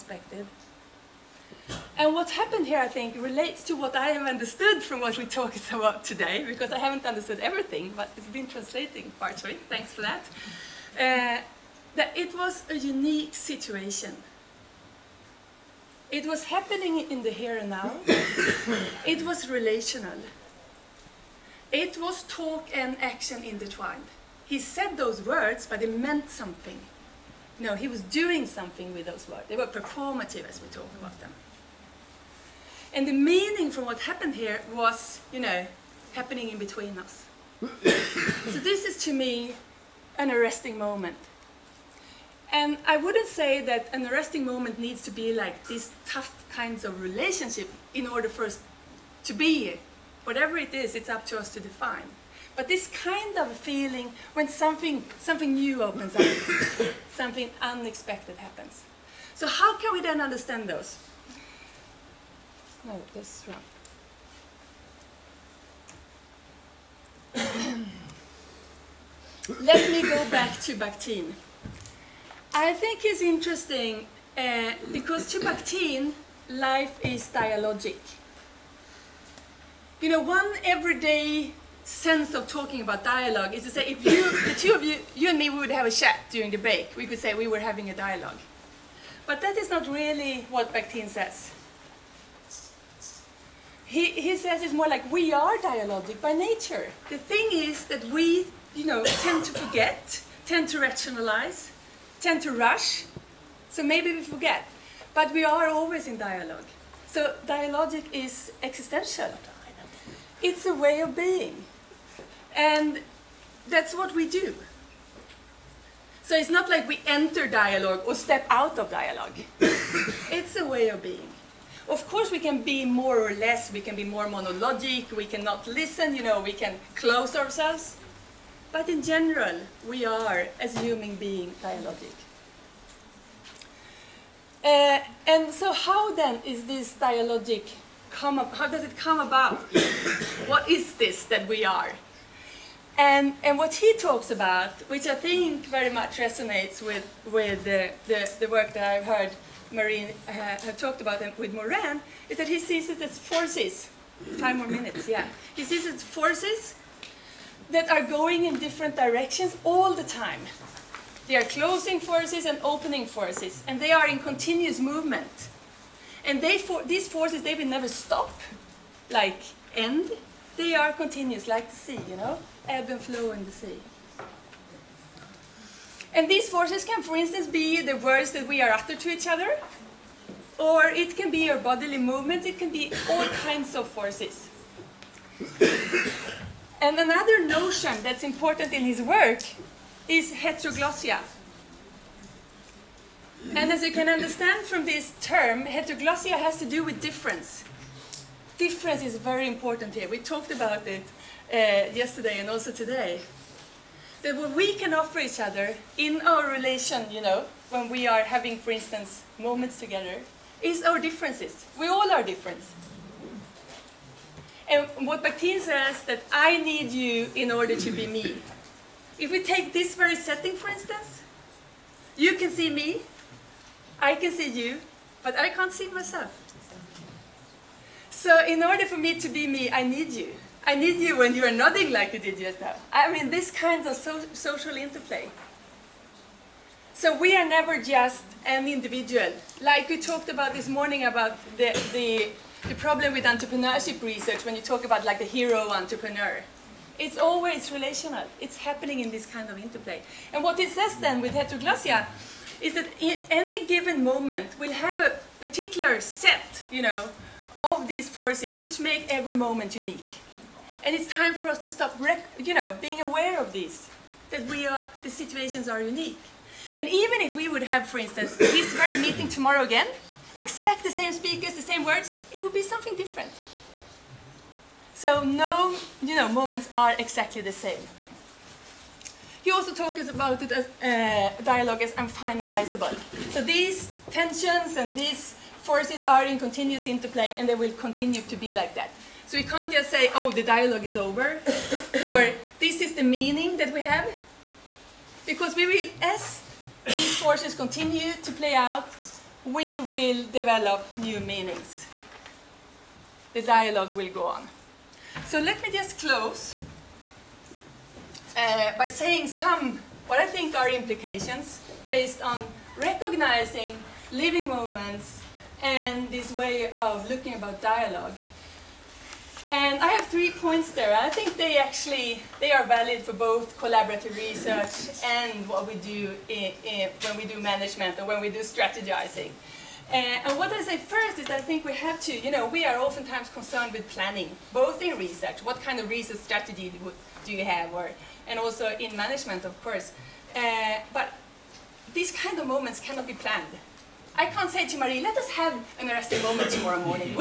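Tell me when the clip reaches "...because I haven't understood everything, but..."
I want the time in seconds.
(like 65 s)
6 s.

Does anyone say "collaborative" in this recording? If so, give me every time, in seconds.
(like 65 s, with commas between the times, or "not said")
323 s.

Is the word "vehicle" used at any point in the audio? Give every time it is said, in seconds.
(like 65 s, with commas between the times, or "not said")
not said.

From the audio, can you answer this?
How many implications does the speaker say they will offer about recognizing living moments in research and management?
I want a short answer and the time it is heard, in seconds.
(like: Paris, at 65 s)
3, at 320 s.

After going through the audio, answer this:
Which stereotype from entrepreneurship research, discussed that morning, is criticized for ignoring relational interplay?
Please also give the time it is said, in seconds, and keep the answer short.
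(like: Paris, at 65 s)
hero entrepreneur, at 245 s.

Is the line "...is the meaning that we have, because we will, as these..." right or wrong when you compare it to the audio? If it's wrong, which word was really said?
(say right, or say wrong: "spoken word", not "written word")
right.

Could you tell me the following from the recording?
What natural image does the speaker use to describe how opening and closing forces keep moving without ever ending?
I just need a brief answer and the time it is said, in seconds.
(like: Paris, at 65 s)
ebb and flow in the sea, at 172 s.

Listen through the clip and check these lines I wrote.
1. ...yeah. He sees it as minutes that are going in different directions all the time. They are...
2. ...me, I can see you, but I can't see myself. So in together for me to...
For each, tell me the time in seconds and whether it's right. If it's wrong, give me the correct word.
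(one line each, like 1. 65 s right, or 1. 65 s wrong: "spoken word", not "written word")
1. 155 s wrong: "forces", not "minutes"
2. 222 s wrong: "order", not "together".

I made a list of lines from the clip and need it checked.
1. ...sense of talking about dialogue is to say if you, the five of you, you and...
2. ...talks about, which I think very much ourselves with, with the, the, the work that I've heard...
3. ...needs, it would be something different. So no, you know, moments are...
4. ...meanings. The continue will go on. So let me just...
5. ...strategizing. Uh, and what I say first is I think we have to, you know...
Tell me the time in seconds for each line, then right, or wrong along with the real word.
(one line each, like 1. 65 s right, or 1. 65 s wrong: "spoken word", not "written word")
1. 81 s wrong: "two", not "five"
2. 143 s wrong: "resonates", not "ourselves"
3. 271 s wrong: "words", not "needs"
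4. 301 s wrong: "dialogue", not "continue"
5. 328 s right.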